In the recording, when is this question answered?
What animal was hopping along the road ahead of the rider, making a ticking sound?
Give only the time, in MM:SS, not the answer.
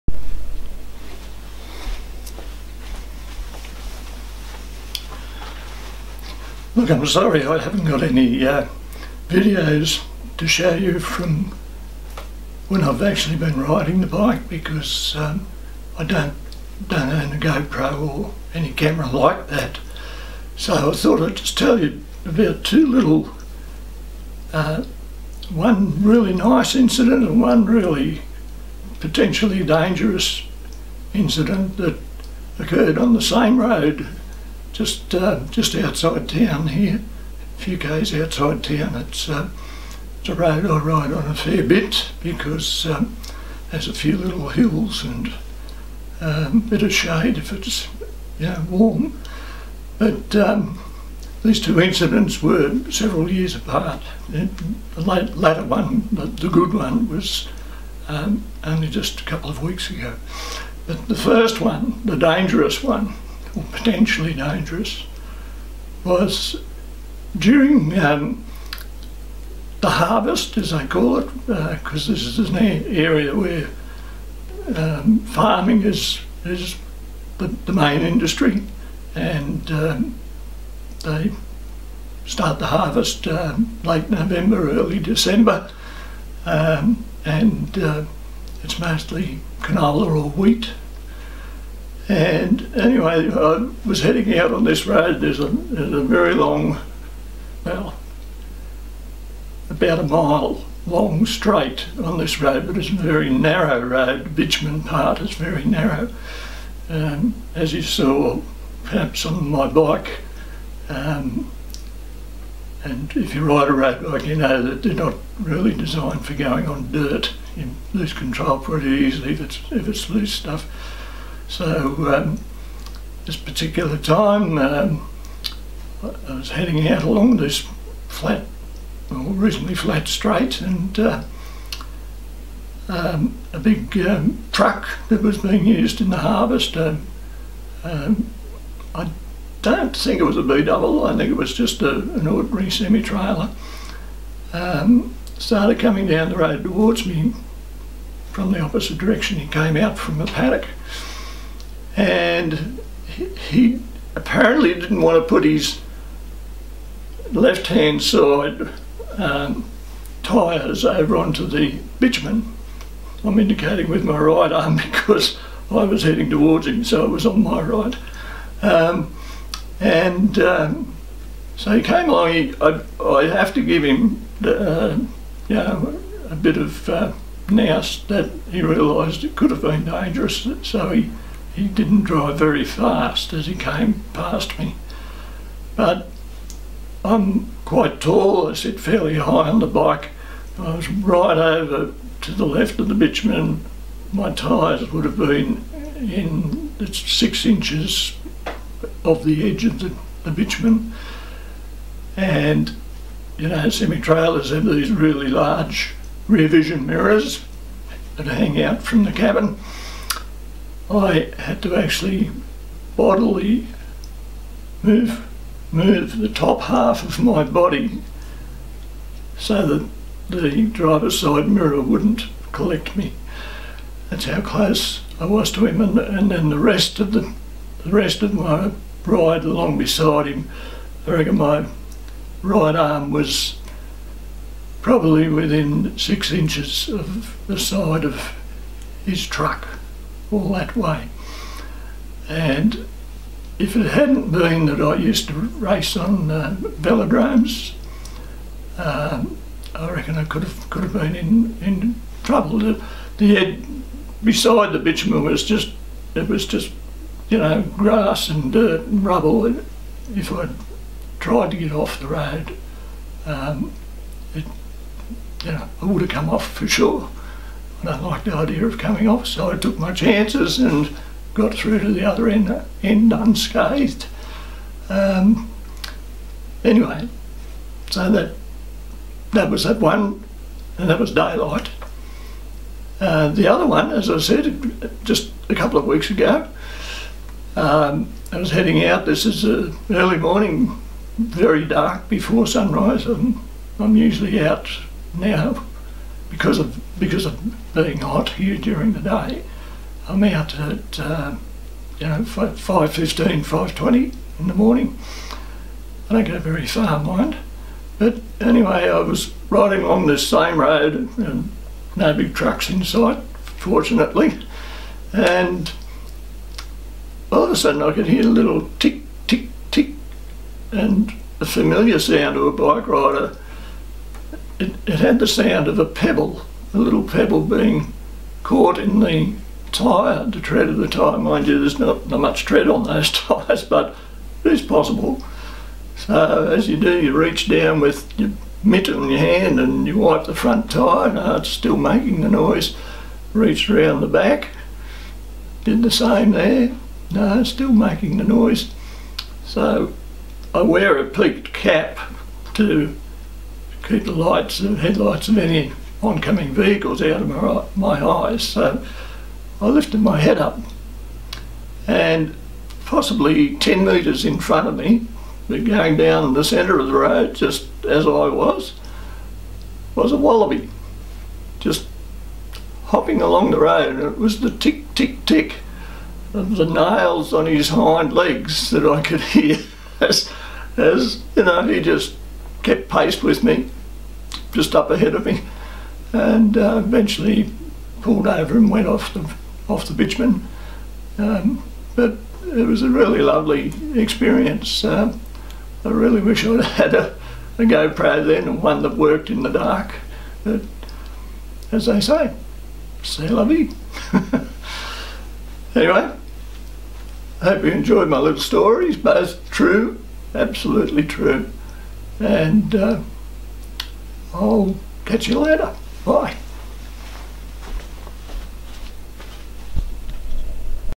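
06:10.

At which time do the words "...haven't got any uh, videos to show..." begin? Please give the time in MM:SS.
00:07.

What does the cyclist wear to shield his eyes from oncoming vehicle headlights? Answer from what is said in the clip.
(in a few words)
a peaked cap.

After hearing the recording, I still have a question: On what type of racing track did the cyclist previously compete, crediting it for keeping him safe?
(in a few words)
velodromes.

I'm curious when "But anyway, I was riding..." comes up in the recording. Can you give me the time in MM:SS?
05:07.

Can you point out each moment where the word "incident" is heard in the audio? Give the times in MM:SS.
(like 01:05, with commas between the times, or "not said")
00:26, 00:31, 00:51.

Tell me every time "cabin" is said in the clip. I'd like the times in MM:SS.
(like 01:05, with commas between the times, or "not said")
03:29.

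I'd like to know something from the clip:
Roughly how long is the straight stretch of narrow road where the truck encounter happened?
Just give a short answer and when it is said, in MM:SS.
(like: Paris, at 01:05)
about a mile, at 01:39.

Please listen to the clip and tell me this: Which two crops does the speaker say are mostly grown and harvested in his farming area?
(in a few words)
canola or wheat.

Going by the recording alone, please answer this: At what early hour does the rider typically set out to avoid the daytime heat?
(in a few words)
5:15.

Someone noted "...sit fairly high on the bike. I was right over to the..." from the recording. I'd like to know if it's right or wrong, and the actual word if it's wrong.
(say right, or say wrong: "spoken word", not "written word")
right.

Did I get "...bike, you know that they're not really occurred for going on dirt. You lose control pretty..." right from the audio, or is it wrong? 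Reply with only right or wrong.
wrong.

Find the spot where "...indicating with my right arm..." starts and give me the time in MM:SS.
02:43.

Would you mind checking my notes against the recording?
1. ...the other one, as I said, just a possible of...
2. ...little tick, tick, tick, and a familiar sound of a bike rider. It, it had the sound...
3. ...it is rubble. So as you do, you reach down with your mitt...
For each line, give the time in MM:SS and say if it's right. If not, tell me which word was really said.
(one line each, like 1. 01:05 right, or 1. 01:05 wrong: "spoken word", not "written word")
1. 04:43 wrong: "couple", not "possible"
2. 05:18 right
3. 05:34 wrong: "possible", not "rubble".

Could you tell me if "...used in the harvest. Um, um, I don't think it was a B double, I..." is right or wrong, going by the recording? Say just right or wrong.
right.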